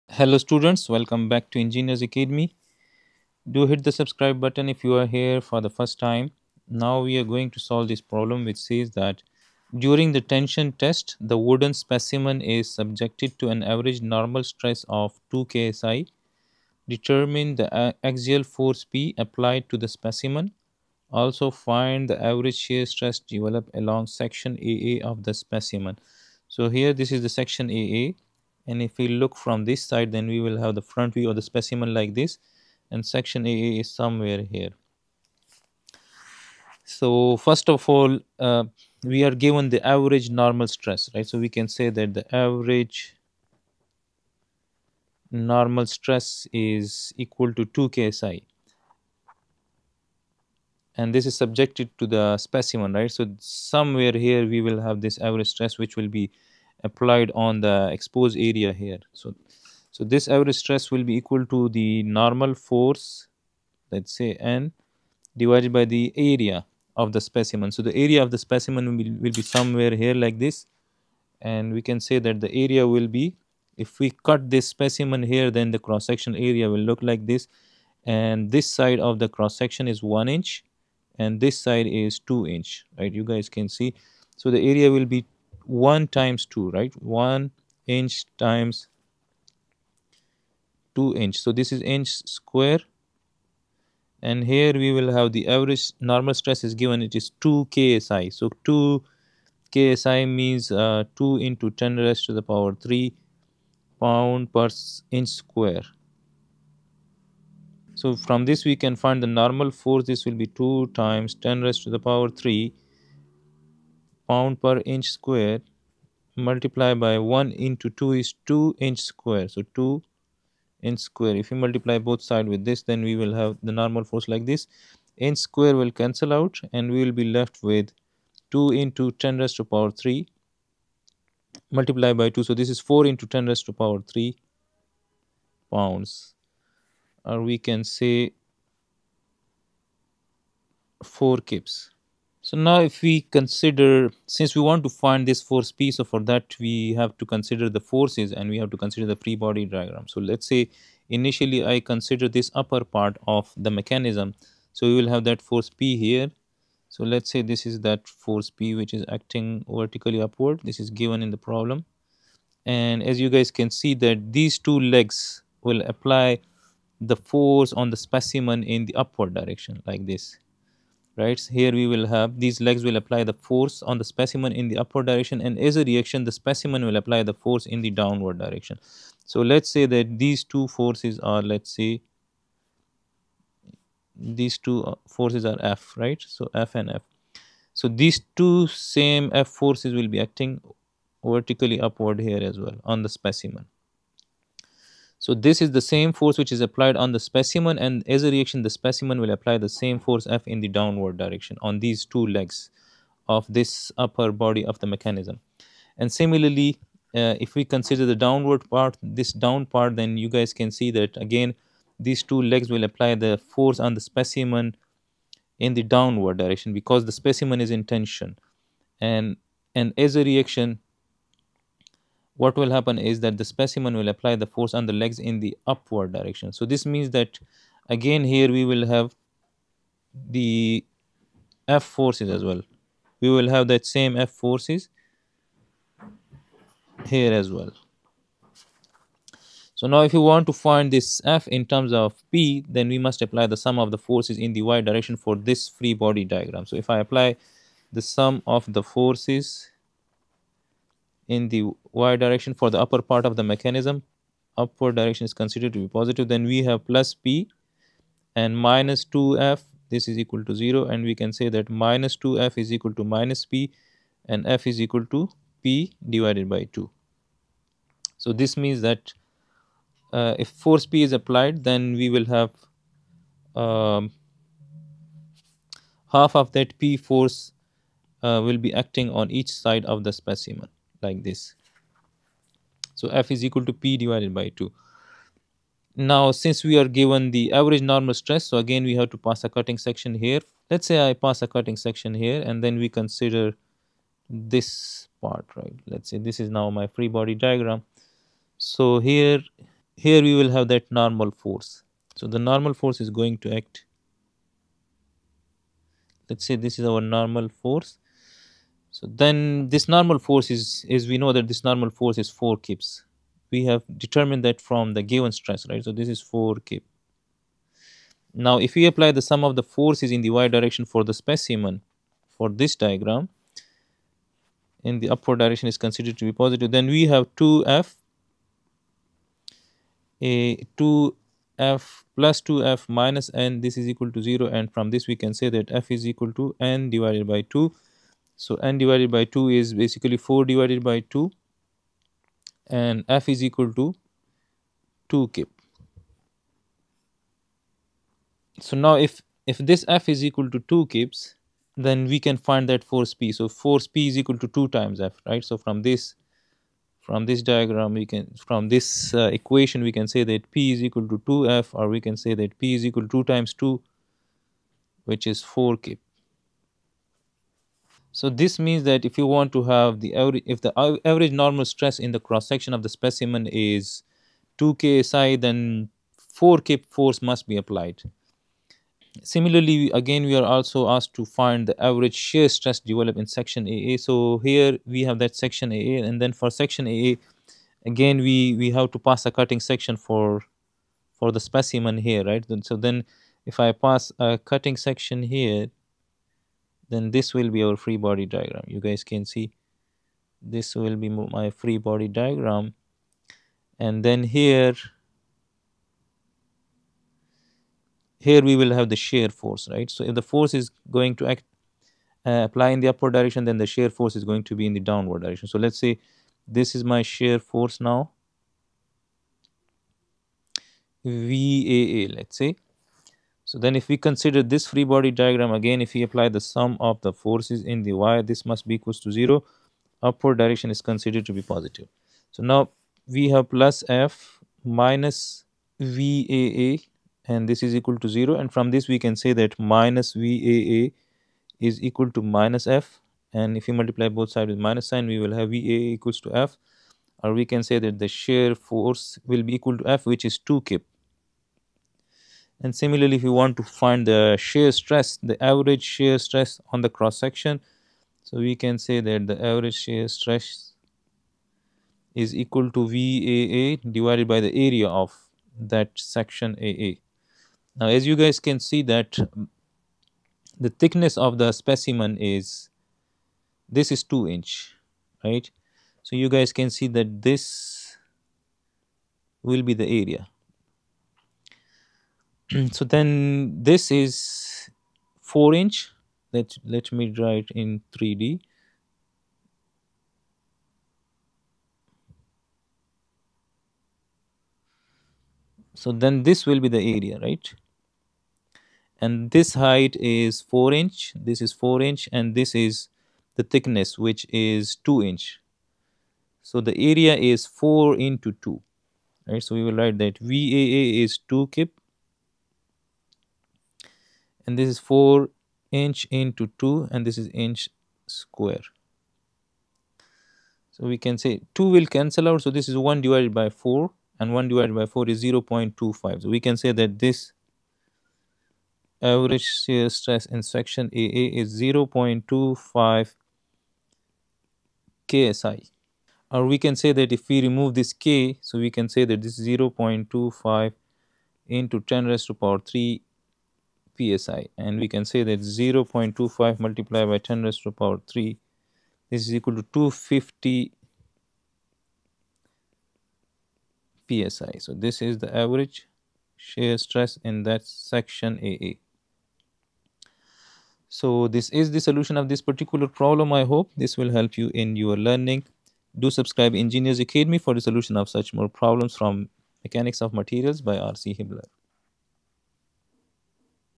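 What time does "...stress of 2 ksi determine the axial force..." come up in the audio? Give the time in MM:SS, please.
00:14.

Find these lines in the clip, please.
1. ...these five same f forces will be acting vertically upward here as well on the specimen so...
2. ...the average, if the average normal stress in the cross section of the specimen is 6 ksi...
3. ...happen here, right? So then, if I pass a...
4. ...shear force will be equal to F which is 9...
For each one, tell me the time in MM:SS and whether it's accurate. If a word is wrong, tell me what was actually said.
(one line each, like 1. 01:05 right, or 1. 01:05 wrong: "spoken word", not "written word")
1. 03:07 wrong: "two", not "five"
2. 06:10 wrong: "2", not "6"
3. 06:31 wrong: "specimen", not "happen"
4. 07:28 wrong: "2", not "9".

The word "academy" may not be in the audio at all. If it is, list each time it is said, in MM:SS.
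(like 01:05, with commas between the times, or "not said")
00:02, 09:26.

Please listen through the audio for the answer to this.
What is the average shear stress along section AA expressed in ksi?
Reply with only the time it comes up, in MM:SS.
08:51.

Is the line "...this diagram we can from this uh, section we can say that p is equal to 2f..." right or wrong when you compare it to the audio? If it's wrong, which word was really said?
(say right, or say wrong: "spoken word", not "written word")
wrong: "equation", not "section".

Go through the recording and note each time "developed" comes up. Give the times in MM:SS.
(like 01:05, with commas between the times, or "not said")
00:23, 06:22.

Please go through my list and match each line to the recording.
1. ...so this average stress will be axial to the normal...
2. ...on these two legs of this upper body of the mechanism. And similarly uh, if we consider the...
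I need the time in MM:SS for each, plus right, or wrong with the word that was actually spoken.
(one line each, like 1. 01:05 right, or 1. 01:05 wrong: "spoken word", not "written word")
1. 00:59 wrong: "equal", not "axial"
2. 03:21 right.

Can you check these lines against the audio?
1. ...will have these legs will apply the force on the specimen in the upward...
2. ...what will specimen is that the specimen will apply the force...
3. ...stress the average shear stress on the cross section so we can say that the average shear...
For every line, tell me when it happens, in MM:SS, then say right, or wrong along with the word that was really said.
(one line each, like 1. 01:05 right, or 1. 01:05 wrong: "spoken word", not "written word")
1. 02:51 right
2. 03:42 wrong: "happen", not "specimen"
3. 07:34 right.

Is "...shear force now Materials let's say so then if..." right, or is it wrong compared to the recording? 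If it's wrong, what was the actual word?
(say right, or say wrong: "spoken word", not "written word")
wrong: "VAA", not "Materials".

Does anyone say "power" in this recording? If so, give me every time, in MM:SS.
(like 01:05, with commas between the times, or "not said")
01:42, 01:51, 02:09, 02:13, 09:02, 09:07.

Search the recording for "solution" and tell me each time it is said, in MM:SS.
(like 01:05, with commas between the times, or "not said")
09:21, 09:27.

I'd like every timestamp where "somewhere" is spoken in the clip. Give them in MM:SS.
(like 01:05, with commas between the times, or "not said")
00:33, 00:53, 01:09.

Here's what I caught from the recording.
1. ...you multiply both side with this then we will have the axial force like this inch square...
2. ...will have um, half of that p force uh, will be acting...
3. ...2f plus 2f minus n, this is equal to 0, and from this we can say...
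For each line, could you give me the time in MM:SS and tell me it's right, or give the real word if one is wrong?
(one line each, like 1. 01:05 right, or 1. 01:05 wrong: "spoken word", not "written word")
1. 02:01 wrong: "normal", not "axial"
2. 04:32 right
3. 05:30 right.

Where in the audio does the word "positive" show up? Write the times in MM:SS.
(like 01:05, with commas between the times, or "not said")
04:15, 05:26, 07:11.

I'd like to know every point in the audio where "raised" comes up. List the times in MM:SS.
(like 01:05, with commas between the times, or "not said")
01:41, 01:51, 02:09, 02:13, 09:02, 09:07.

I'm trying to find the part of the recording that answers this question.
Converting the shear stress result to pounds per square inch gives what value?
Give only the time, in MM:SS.
09:09.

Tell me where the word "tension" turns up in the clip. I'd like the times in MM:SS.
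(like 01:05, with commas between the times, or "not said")
00:10, 03:37.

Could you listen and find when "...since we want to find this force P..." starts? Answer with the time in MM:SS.
02:24.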